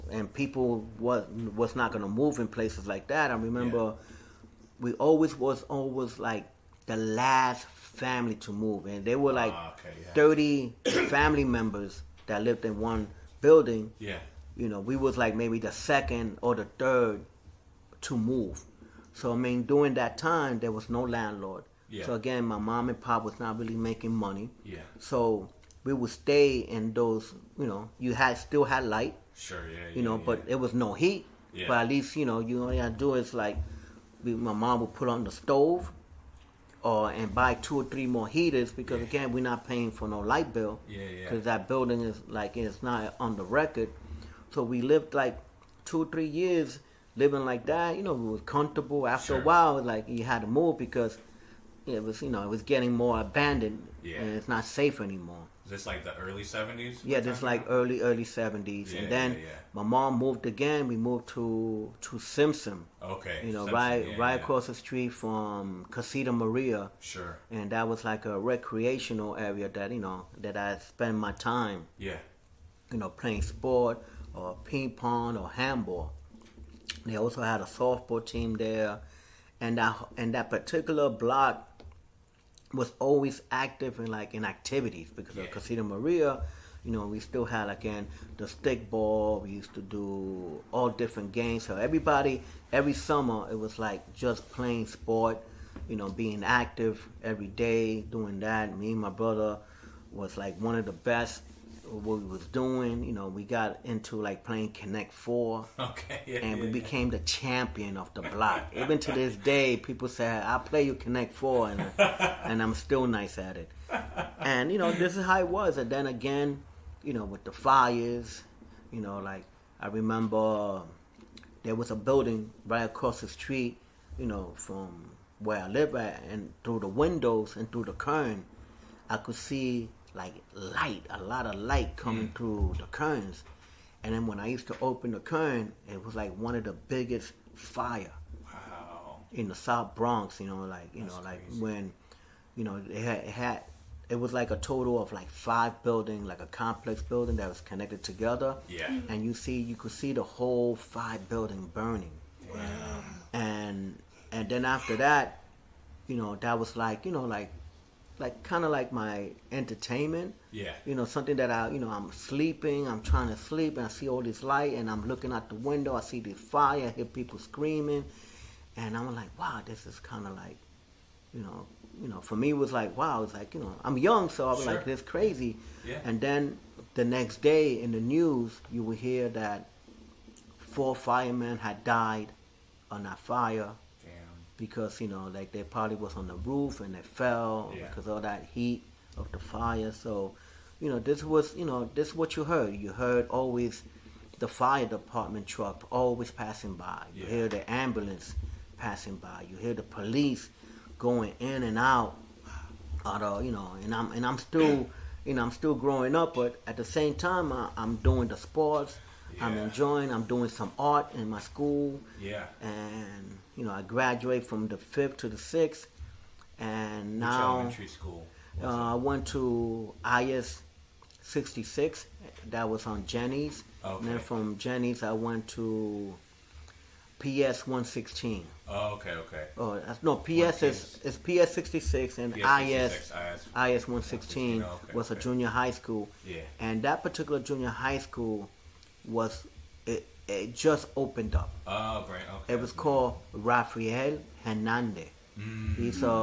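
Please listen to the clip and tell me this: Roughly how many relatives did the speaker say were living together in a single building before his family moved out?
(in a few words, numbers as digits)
30.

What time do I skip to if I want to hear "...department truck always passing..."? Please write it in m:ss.
3:14.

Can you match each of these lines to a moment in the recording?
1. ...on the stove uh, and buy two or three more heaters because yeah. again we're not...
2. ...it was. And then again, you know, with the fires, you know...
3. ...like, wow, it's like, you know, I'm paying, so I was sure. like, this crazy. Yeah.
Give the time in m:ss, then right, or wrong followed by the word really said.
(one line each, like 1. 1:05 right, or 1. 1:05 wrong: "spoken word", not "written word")
1. 0:35 right
2. 1:55 right
3. 2:52 wrong: "young", not "paying".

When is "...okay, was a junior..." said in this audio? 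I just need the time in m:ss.
3:54.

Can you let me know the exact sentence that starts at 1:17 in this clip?
They also had a softball team there, and that and that particular block was always active in like in activities because yeah.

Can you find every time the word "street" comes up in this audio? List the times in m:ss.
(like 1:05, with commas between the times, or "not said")
1:04, 2:03.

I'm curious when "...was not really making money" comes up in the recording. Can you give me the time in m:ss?
0:23.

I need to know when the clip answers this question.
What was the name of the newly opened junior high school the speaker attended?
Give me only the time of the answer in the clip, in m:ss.
4:03.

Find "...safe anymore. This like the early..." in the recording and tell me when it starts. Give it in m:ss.
0:54.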